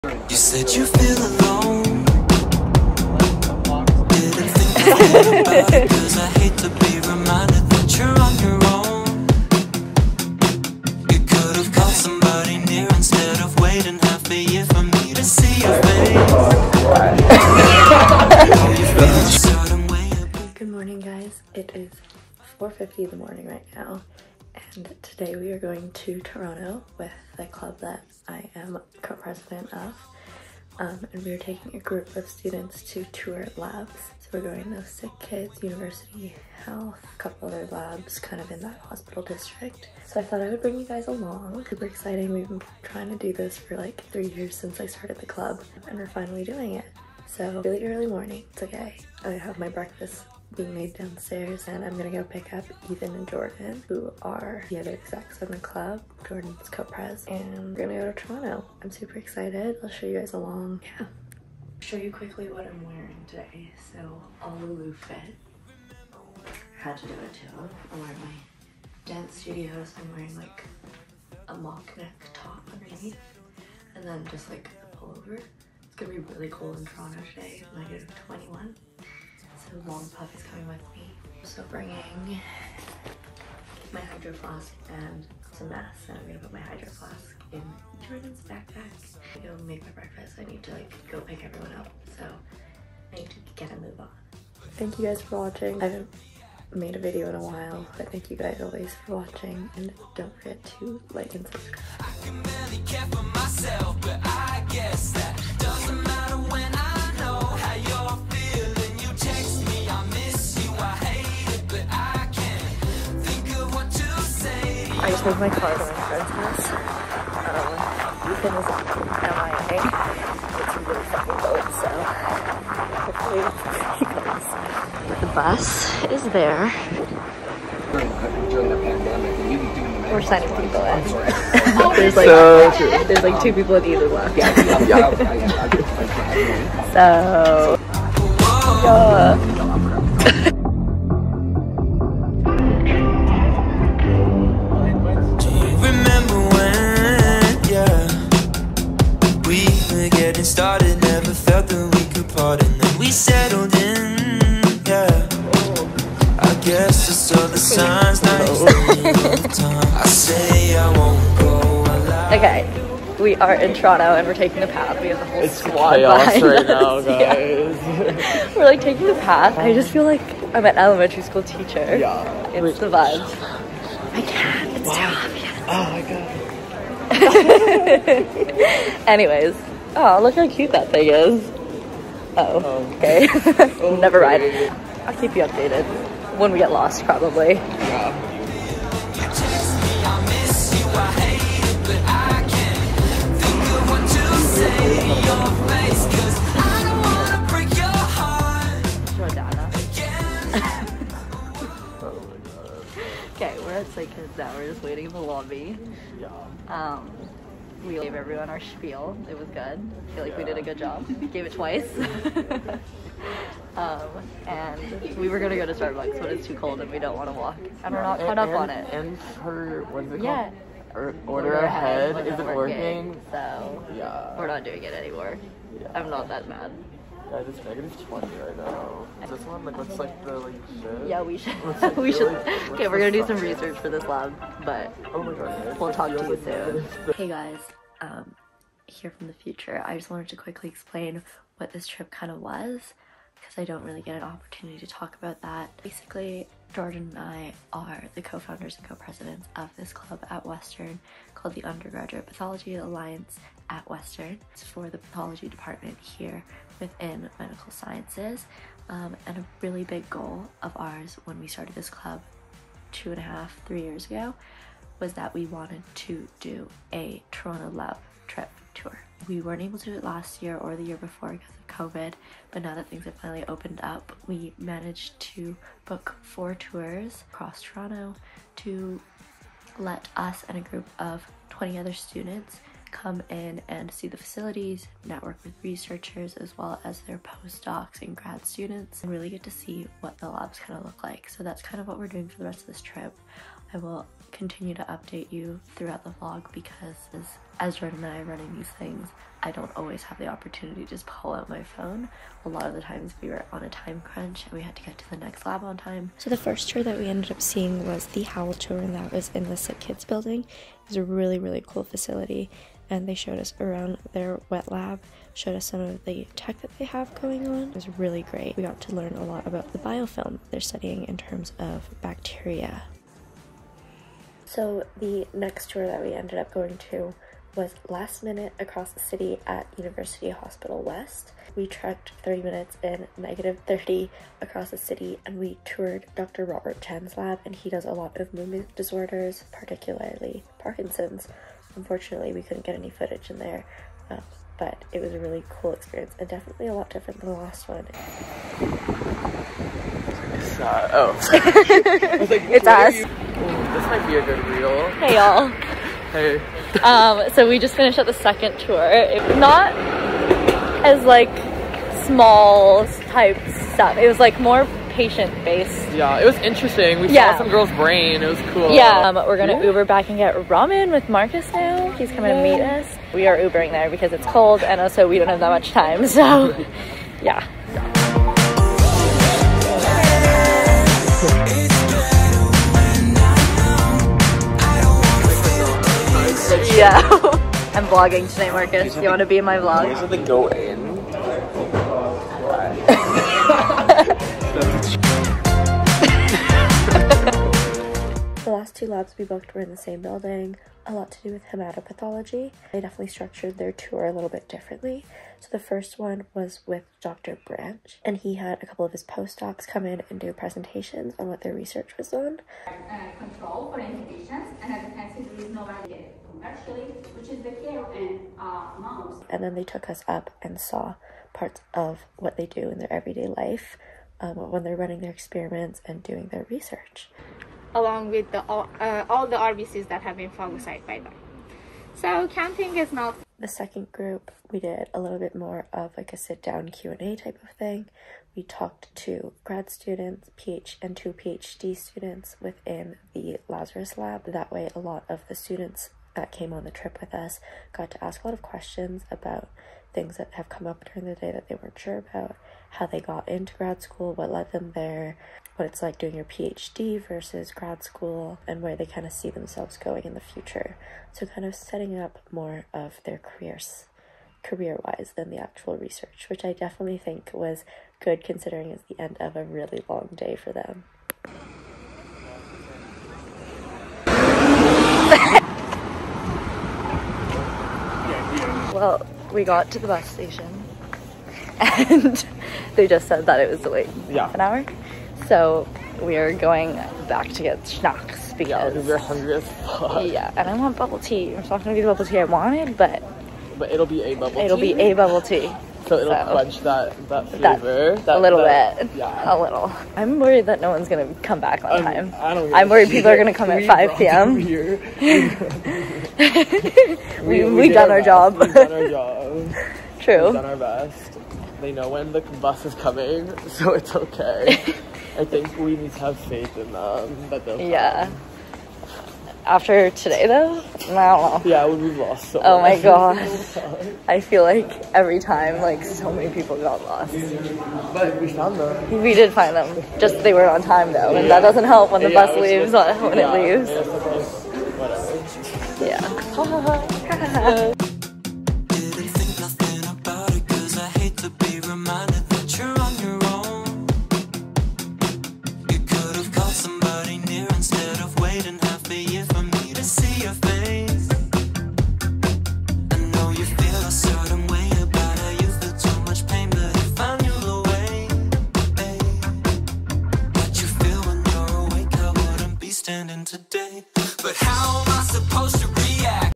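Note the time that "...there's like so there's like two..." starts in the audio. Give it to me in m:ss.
2:11.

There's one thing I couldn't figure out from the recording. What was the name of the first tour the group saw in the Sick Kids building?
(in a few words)
Howell.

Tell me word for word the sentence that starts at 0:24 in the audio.
And today we are going to Toronto with the club that I am co-president of.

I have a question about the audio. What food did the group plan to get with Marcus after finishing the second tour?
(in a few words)
Ramen.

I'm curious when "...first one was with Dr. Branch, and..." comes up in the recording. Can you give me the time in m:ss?
6:45.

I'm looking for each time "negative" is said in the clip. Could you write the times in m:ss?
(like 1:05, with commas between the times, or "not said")
1:17, 3:47, 5:33.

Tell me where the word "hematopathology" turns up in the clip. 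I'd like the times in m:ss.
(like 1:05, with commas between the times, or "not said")
6:41.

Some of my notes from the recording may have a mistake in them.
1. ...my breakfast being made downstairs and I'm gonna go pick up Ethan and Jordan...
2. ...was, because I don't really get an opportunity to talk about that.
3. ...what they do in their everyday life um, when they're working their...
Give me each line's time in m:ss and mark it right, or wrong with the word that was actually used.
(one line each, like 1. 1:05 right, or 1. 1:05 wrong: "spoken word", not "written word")
1. 0:49 right
2. 4:02 right
3. 7:02 wrong: "running", not "working".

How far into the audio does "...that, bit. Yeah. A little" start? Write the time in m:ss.
8:18.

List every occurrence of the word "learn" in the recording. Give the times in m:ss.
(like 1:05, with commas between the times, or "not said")
5:18.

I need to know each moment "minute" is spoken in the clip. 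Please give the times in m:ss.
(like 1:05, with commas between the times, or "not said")
5:28, 5:32.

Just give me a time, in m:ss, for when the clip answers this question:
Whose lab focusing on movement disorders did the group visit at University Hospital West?
5:36.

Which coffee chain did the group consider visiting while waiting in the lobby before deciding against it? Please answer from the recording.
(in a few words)
Starbucks.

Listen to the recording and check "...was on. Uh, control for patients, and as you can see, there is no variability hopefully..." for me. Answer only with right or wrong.
wrong.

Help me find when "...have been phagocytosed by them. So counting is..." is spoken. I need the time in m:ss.
7:10.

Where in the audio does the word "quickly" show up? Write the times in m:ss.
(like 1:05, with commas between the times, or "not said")
1:02, 4:00.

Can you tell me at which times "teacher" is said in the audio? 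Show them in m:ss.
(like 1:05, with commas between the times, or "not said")
2:51.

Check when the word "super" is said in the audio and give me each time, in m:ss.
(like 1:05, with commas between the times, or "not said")
0:41, 0:58.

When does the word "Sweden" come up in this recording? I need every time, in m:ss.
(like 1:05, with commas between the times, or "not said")
not said.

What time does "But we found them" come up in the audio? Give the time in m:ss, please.
8:47.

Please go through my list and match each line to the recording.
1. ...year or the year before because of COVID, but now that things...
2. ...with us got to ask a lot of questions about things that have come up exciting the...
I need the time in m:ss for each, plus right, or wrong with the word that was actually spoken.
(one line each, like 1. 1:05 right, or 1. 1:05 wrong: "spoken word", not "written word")
1. 4:30 right
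2. 7:27 wrong: "during", not "exciting".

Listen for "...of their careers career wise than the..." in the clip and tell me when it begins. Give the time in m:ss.
7:42.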